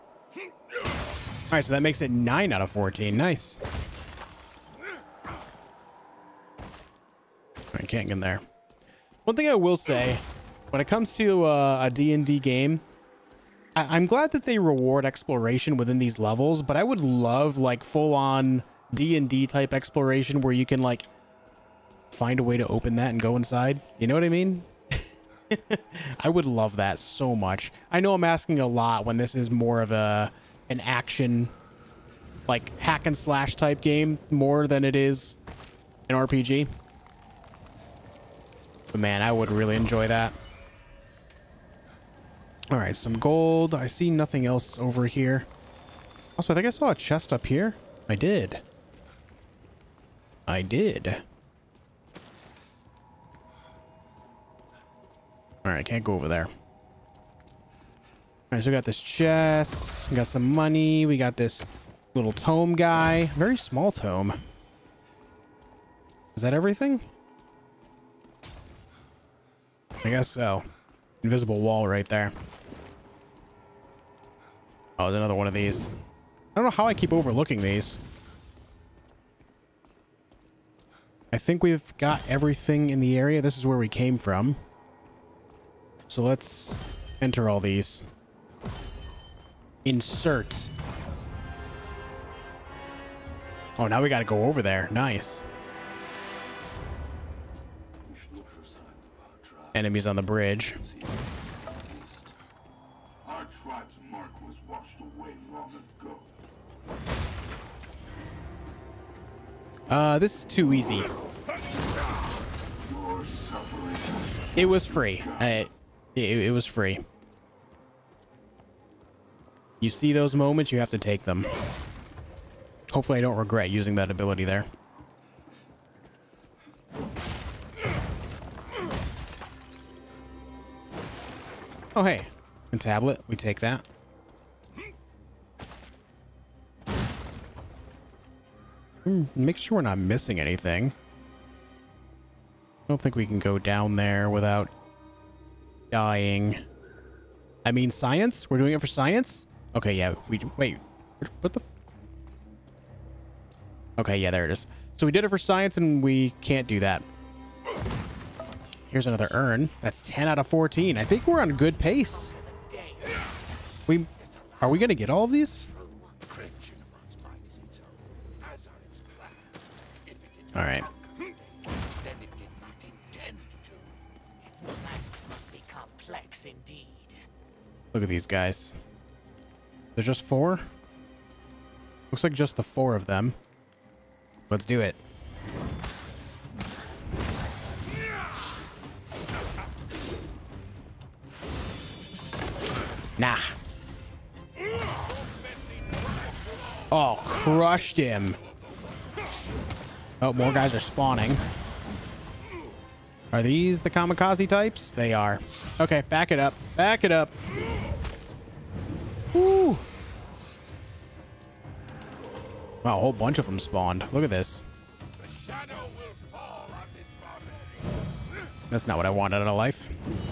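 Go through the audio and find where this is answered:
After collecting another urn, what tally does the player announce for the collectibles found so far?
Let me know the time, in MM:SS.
02:40.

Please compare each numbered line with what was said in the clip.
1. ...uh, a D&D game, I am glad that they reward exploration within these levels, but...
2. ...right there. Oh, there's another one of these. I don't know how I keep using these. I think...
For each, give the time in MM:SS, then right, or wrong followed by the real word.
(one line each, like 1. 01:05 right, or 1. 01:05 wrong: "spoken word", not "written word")
1. 00:11 right
2. 01:11 wrong: "overlooking", not "using".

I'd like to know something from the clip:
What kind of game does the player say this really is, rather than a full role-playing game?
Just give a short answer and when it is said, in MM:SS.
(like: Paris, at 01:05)
hack and slash, at 00:32.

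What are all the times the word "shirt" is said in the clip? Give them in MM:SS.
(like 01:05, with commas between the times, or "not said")
not said.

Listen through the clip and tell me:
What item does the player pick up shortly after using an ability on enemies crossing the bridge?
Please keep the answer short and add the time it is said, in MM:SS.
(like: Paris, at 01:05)
A tablet, at 02:12.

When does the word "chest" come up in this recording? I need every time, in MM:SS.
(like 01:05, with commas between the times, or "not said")
00:46, 00:59.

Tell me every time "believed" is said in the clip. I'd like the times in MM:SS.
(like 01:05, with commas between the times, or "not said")
not said.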